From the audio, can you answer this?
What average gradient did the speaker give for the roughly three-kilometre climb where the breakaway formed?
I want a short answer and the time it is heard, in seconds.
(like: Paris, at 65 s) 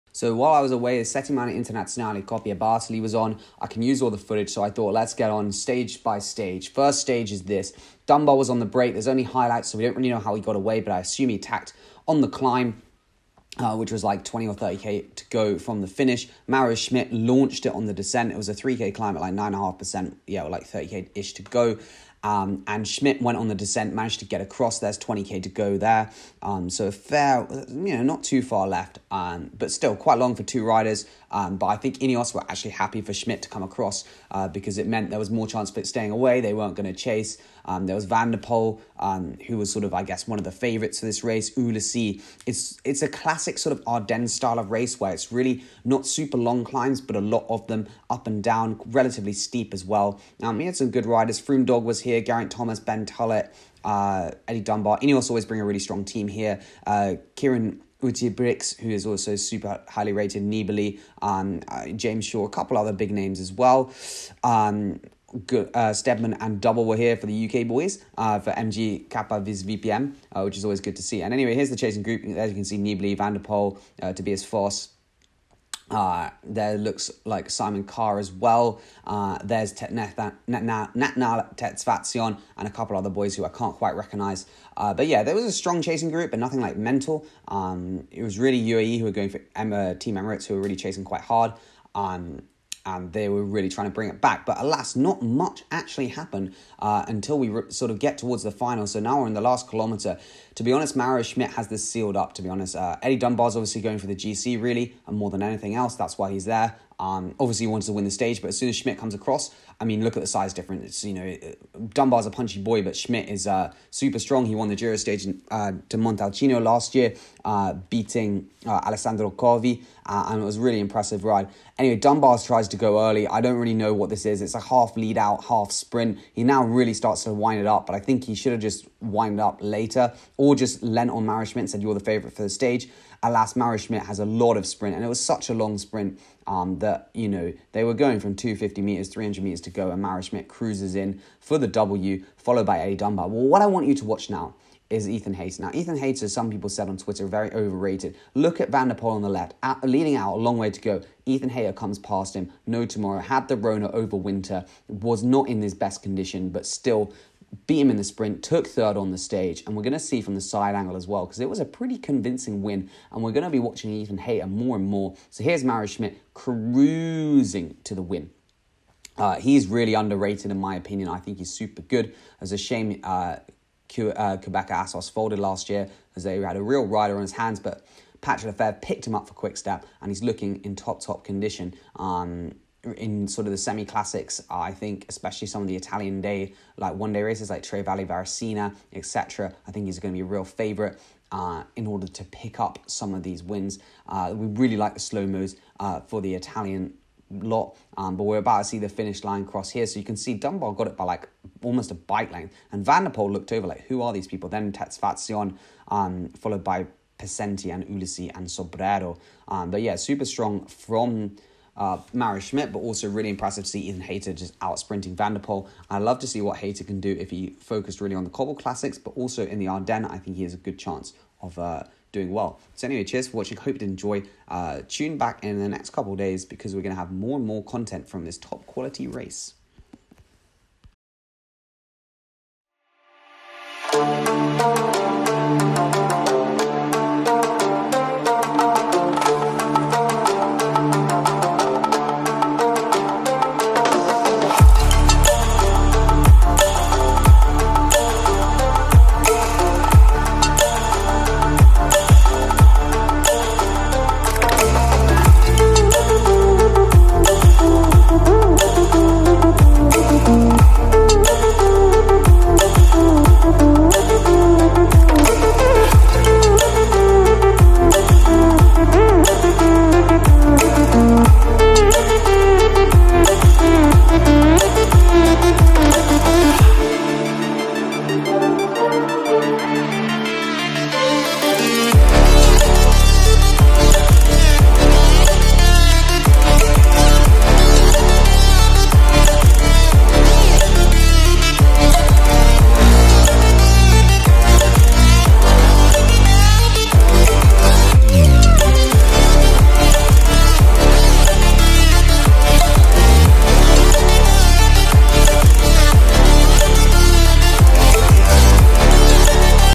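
9.5%, at 19 s.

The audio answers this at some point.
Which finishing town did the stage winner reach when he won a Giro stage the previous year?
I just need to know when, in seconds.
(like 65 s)
115 s.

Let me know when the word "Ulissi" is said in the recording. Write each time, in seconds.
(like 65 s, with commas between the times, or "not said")
41 s, 207 s.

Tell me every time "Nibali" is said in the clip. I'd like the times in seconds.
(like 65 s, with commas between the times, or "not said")
60 s, 72 s.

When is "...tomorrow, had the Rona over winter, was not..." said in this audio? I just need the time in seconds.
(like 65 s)
152 s.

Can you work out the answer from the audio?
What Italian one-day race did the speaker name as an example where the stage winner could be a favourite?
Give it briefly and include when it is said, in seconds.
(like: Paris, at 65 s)
Tre Valli Varesine, at 187 s.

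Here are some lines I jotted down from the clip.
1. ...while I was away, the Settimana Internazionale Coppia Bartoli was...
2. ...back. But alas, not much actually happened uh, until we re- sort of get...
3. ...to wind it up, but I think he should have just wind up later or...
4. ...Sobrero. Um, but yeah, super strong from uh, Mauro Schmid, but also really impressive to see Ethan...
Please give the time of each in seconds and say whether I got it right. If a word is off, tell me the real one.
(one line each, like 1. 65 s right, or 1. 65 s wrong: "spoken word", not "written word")
1. 0 s right
2. 94 s right
3. 127 s right
4. 208 s right.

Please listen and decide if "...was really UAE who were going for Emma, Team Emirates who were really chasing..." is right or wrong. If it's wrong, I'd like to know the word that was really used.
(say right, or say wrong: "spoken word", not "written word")
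right.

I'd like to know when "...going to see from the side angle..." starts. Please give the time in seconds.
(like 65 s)
159 s.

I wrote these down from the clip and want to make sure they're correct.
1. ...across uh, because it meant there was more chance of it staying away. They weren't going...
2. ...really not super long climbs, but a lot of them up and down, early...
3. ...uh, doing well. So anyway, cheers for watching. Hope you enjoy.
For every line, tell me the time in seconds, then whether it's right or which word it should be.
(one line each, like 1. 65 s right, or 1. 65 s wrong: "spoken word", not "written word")
1. 33 s right
2. 45 s wrong: "relatively", not "early"
3. 221 s right.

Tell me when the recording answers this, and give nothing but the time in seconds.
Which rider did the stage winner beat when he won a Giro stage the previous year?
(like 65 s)
118 s.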